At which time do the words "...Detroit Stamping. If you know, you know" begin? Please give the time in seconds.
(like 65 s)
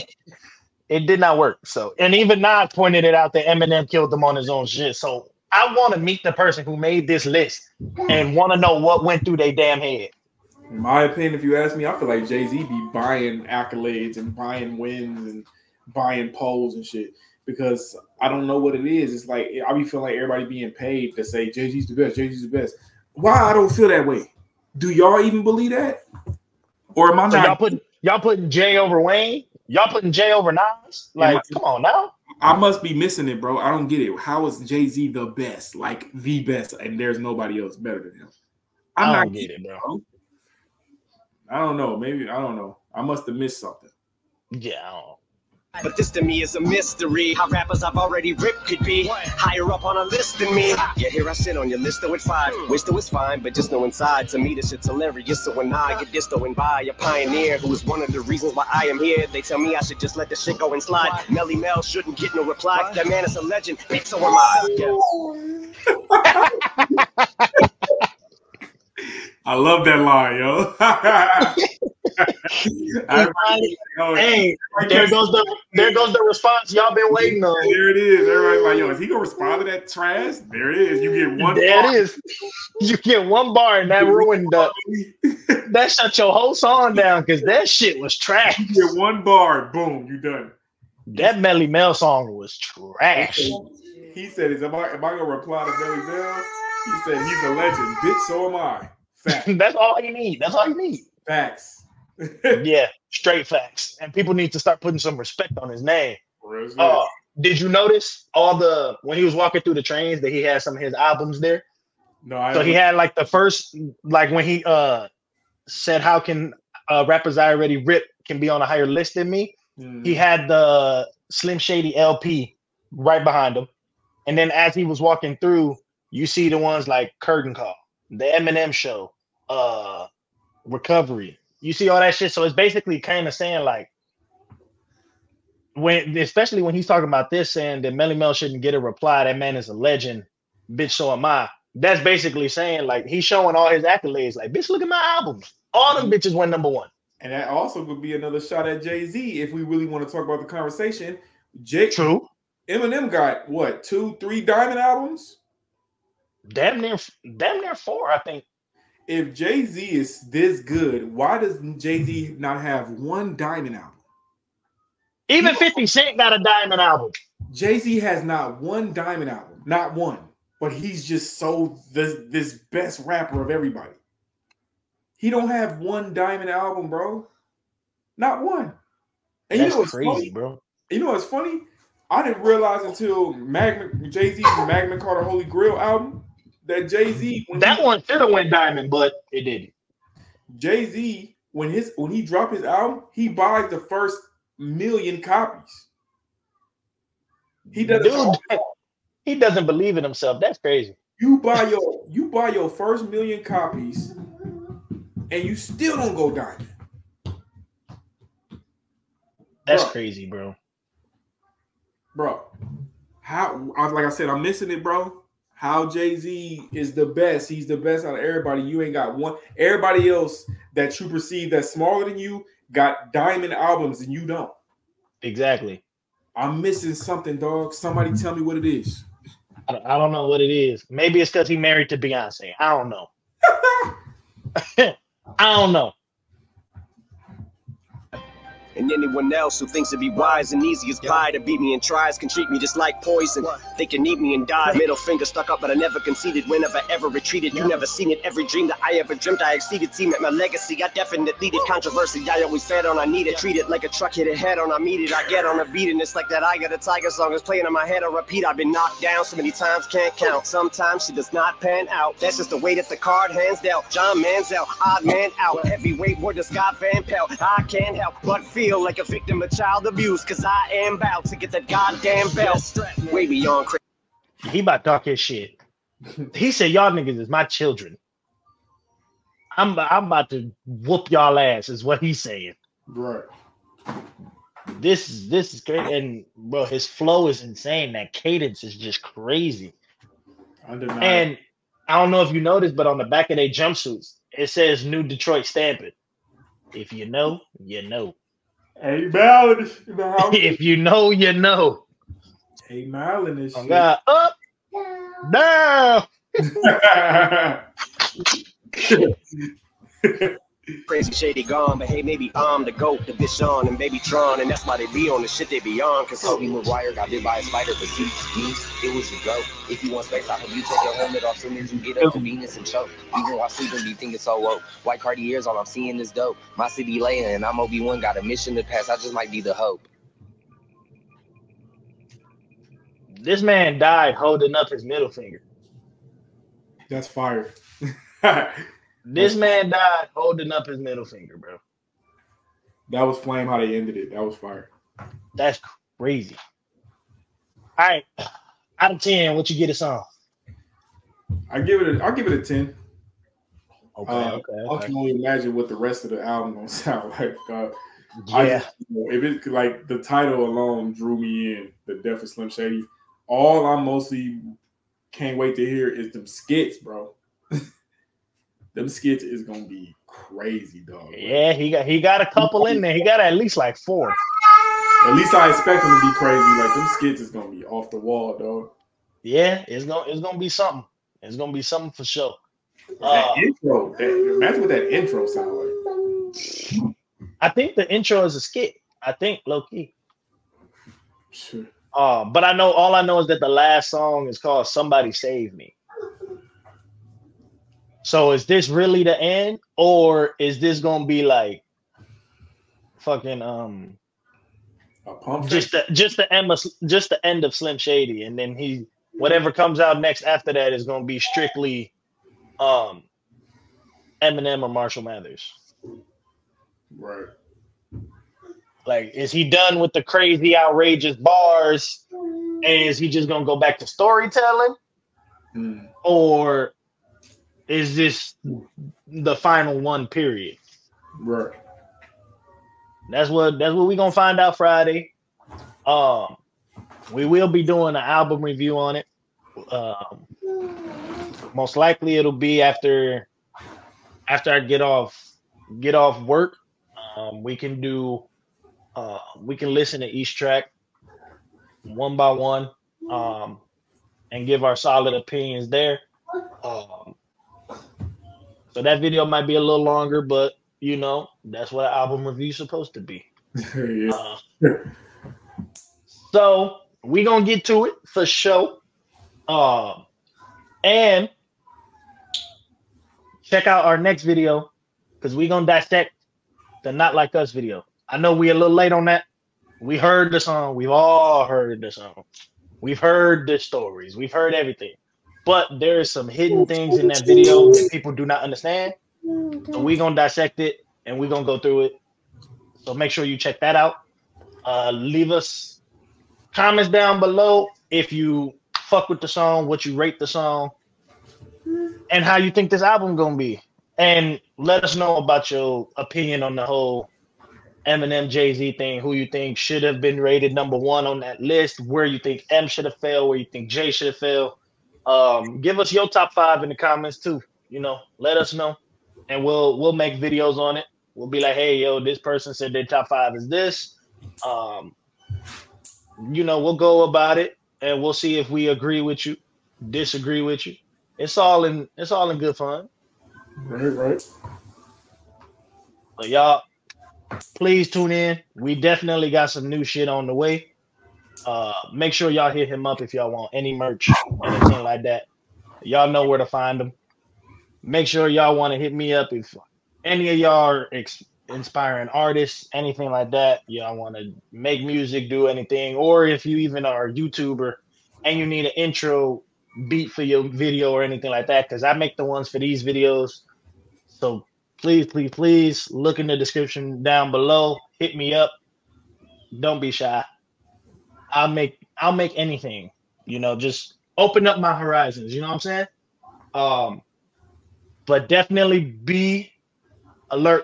295 s.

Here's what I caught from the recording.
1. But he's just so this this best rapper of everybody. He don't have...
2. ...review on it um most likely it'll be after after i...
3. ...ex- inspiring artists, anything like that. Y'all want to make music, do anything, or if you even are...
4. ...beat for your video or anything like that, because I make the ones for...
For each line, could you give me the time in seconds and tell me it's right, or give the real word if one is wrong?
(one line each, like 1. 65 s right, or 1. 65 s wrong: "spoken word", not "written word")
1. 170 s right
2. 438 s right
3. 550 s right
4. 559 s right.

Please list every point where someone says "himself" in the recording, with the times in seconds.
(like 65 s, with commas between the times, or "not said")
200 s.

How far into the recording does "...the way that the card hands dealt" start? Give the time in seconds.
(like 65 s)
262 s.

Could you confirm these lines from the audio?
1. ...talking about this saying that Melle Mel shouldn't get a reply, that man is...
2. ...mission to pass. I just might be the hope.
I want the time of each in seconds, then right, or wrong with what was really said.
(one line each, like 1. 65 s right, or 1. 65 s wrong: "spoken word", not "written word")
1. 136 s right
2. 328 s right.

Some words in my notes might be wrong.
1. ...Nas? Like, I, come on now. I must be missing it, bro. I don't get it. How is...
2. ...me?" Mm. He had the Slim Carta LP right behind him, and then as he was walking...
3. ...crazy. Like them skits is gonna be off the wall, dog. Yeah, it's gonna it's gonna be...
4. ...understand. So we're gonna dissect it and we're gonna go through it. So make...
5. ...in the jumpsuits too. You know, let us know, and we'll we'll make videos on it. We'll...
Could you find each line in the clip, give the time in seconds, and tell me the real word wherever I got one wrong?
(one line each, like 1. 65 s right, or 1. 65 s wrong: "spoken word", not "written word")
1. 30 s right
2. 119 s wrong: "Shady", not "Carta"
3. 376 s right
4. 488 s right
5. 516 s wrong: "comments", not "jumpsuits".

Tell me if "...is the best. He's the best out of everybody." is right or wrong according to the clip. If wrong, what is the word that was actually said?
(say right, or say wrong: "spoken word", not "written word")
right.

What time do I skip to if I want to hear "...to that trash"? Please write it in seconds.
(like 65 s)
79 s.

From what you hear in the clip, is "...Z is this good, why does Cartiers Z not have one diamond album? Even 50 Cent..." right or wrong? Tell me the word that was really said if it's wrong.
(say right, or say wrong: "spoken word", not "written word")
wrong: "Jay", not "Cartiers".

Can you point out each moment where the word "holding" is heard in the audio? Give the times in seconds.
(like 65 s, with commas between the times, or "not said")
334 s, 340 s.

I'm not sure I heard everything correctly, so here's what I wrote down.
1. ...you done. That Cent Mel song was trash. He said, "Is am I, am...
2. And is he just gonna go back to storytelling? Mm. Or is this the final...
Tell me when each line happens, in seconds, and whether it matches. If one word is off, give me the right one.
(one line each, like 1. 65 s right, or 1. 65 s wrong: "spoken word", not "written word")
1. 90 s wrong: "Melle", not "Cent"
2. 422 s right.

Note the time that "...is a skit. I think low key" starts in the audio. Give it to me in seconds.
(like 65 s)
388 s.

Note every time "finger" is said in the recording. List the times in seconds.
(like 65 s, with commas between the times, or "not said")
244 s, 335 s, 341 s.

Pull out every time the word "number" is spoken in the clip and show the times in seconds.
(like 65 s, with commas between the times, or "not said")
146 s, 510 s.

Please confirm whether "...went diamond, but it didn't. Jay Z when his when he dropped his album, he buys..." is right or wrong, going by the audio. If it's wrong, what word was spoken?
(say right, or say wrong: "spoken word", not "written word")
right.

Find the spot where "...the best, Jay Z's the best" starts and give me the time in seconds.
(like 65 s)
21 s.